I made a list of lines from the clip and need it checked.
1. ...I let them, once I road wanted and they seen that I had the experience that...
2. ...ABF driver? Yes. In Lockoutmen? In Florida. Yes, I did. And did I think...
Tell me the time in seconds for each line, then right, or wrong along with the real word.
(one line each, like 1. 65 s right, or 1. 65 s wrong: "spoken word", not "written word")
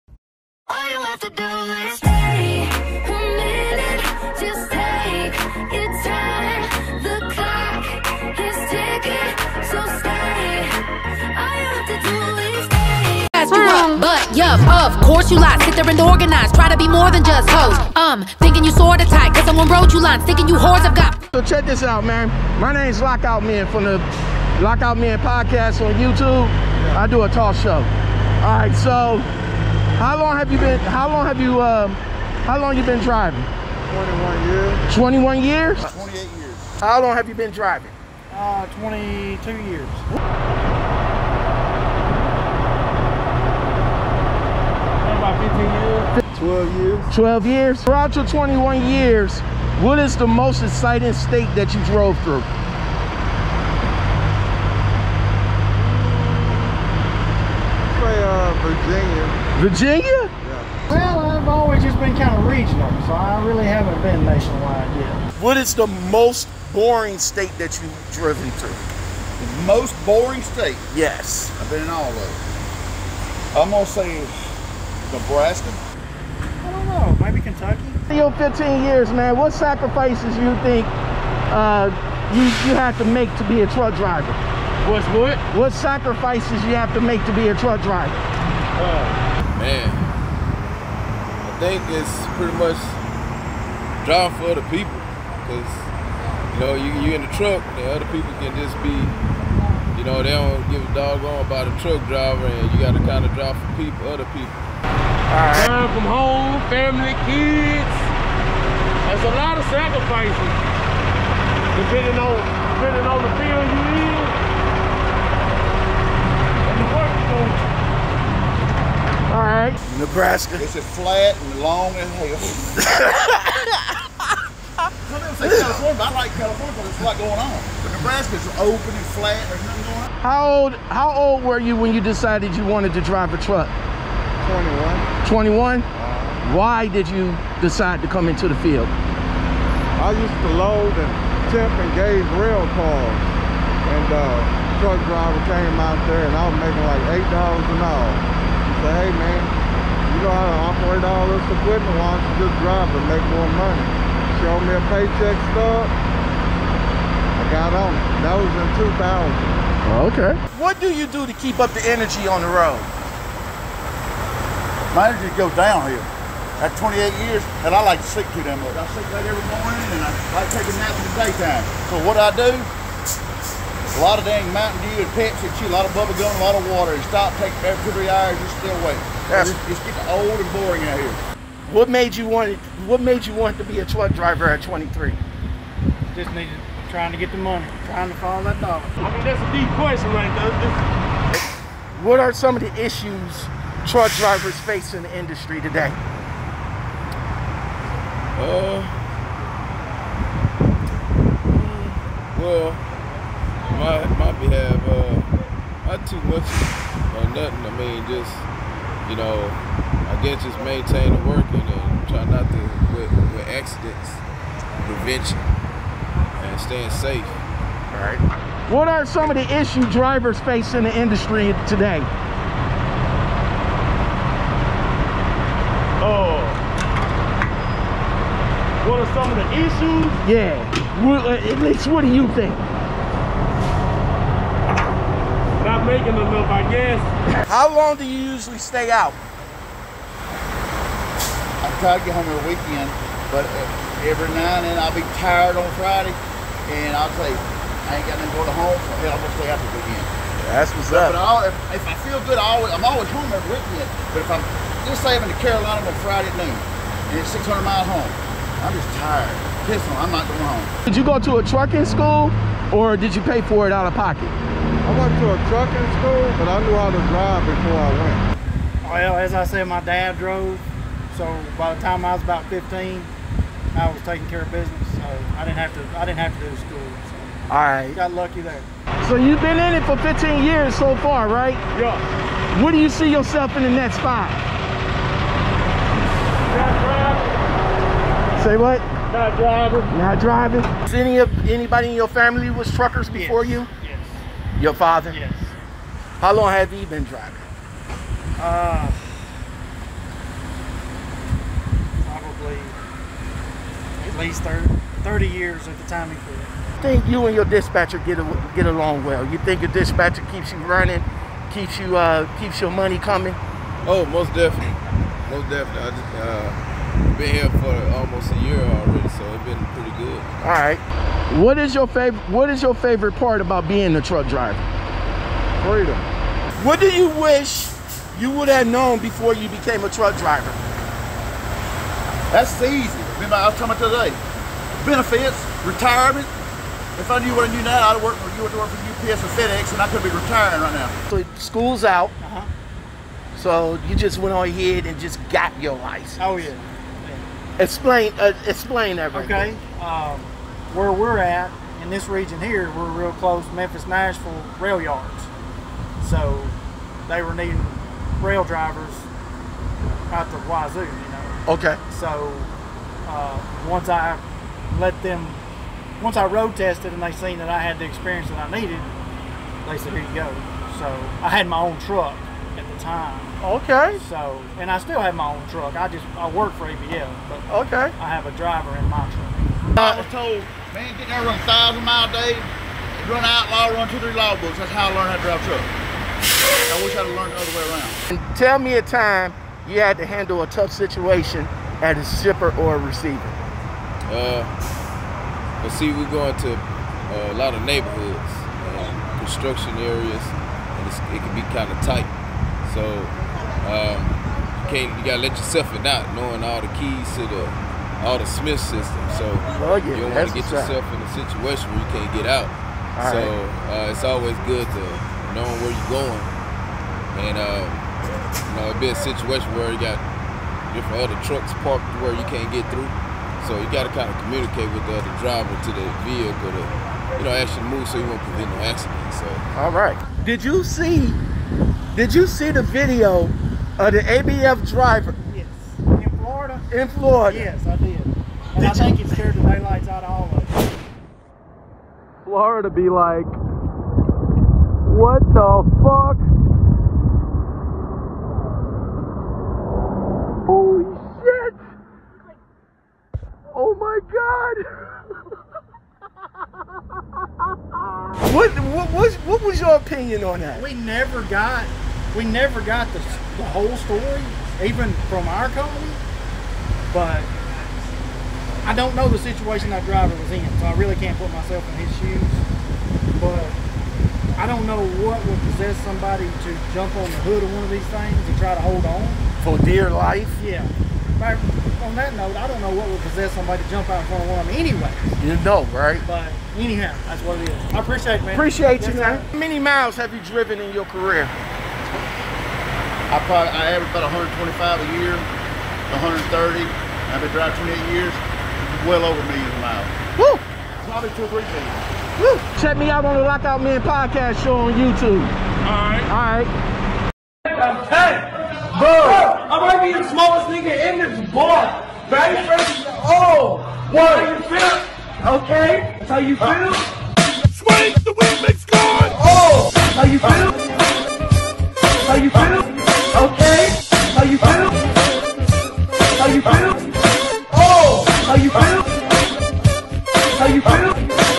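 1. 363 s wrong: "tested", not "wanted"
2. 433 s wrong: "Florida", not "Lockoutmen".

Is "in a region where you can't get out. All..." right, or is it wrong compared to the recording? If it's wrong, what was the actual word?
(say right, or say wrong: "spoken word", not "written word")
wrong: "situation", not "region".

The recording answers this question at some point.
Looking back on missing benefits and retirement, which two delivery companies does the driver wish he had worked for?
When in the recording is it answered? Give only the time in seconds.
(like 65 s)
339 s.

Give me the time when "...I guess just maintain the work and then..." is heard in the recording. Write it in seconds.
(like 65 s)
209 s.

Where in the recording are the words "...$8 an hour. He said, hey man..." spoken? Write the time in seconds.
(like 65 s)
147 s.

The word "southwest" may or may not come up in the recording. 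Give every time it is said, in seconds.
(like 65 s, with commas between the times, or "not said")
not said.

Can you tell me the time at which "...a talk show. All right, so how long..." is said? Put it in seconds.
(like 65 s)
27 s.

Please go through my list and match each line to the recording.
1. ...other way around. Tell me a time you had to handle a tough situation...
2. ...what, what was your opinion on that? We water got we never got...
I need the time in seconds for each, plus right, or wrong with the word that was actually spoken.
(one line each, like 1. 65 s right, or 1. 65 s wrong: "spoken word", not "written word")
1. 387 s right
2. 458 s wrong: "never", not "water".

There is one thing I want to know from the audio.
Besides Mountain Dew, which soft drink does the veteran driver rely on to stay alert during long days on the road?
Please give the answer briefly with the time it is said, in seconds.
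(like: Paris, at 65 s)
Pepsi, at 175 s.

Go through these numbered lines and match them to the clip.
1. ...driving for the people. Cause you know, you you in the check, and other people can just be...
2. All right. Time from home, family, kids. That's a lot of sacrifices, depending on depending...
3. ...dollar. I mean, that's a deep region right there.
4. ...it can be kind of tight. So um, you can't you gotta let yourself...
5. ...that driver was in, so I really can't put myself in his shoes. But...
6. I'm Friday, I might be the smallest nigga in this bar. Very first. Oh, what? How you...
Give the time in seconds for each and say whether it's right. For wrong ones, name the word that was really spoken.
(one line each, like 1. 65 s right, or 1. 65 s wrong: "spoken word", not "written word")
1. 94 s wrong: "truck", not "check"
2. 104 s right
3. 188 s wrong: "question", not "region"
4. 401 s right
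5. 469 s right
6. 507 s wrong: "Bro", not "Friday".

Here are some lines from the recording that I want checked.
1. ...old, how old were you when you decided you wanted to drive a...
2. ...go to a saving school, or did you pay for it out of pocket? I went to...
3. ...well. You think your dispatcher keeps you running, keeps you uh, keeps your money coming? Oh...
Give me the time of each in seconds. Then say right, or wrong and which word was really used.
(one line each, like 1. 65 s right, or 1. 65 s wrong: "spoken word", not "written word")
1. 130 s right
2. 261 s wrong: "trucking", not "saving"
3. 309 s right.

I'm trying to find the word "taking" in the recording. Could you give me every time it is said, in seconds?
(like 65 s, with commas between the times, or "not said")
170 s, 274 s.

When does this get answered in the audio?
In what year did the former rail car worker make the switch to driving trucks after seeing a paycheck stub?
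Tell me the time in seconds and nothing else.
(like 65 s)
158 s.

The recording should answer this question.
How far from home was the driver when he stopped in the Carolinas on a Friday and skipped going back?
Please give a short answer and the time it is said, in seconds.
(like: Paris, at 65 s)
600 miles, at 257 s.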